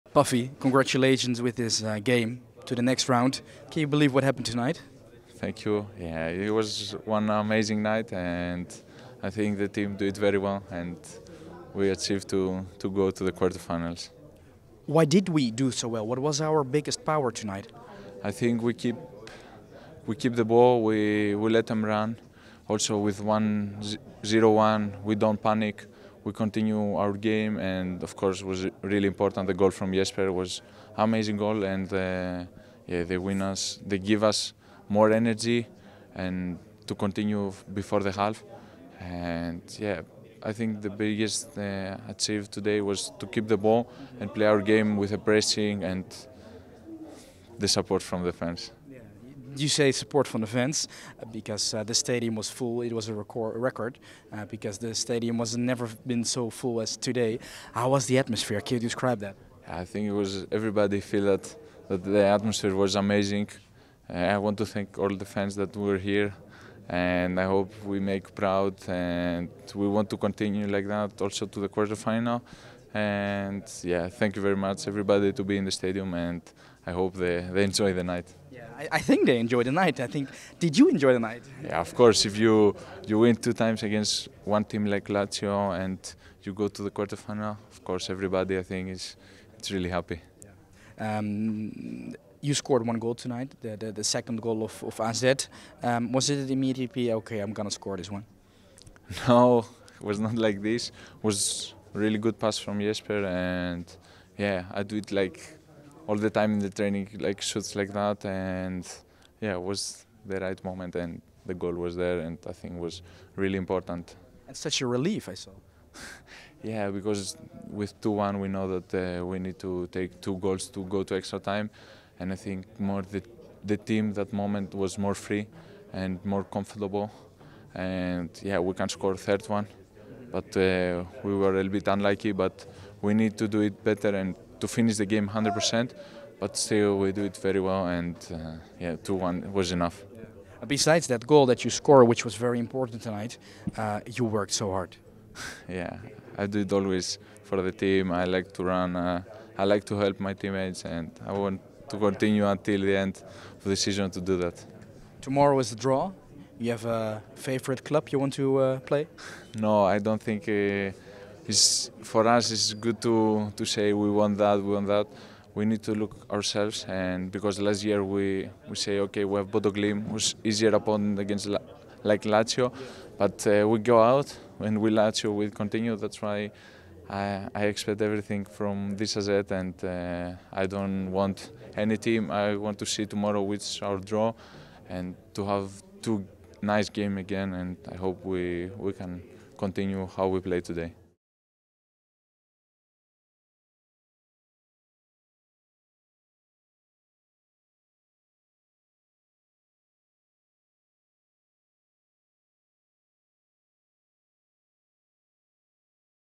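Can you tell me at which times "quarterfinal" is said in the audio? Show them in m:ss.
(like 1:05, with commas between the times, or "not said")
0:13, 1:11, 1:26.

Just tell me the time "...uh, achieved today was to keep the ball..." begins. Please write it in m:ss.
0:41.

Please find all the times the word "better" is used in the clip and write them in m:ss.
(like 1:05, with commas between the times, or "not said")
2:13.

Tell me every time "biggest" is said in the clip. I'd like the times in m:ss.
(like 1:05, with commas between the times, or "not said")
0:16, 0:41.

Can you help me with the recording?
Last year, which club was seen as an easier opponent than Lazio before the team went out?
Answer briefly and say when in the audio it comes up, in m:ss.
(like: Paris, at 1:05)
Bodø/Glimt, at 2:49.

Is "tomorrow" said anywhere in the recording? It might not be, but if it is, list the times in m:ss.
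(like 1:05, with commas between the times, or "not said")
2:35, 3:03.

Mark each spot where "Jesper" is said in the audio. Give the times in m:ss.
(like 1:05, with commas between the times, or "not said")
0:29, 1:42.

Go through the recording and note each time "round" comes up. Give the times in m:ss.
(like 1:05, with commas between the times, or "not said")
0:03.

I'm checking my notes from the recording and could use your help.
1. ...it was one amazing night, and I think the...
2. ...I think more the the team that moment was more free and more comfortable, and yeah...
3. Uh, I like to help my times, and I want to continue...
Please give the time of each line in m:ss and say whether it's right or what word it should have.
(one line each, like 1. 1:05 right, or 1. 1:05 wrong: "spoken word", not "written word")
1. 0:06 right
2. 2:02 right
3. 2:28 wrong: "teammates", not "times".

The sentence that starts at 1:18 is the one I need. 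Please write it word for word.
I, I, think they enjoyed the night.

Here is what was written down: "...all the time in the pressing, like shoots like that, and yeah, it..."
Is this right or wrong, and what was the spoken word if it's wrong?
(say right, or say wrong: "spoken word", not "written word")
wrong: "training", not "pressing".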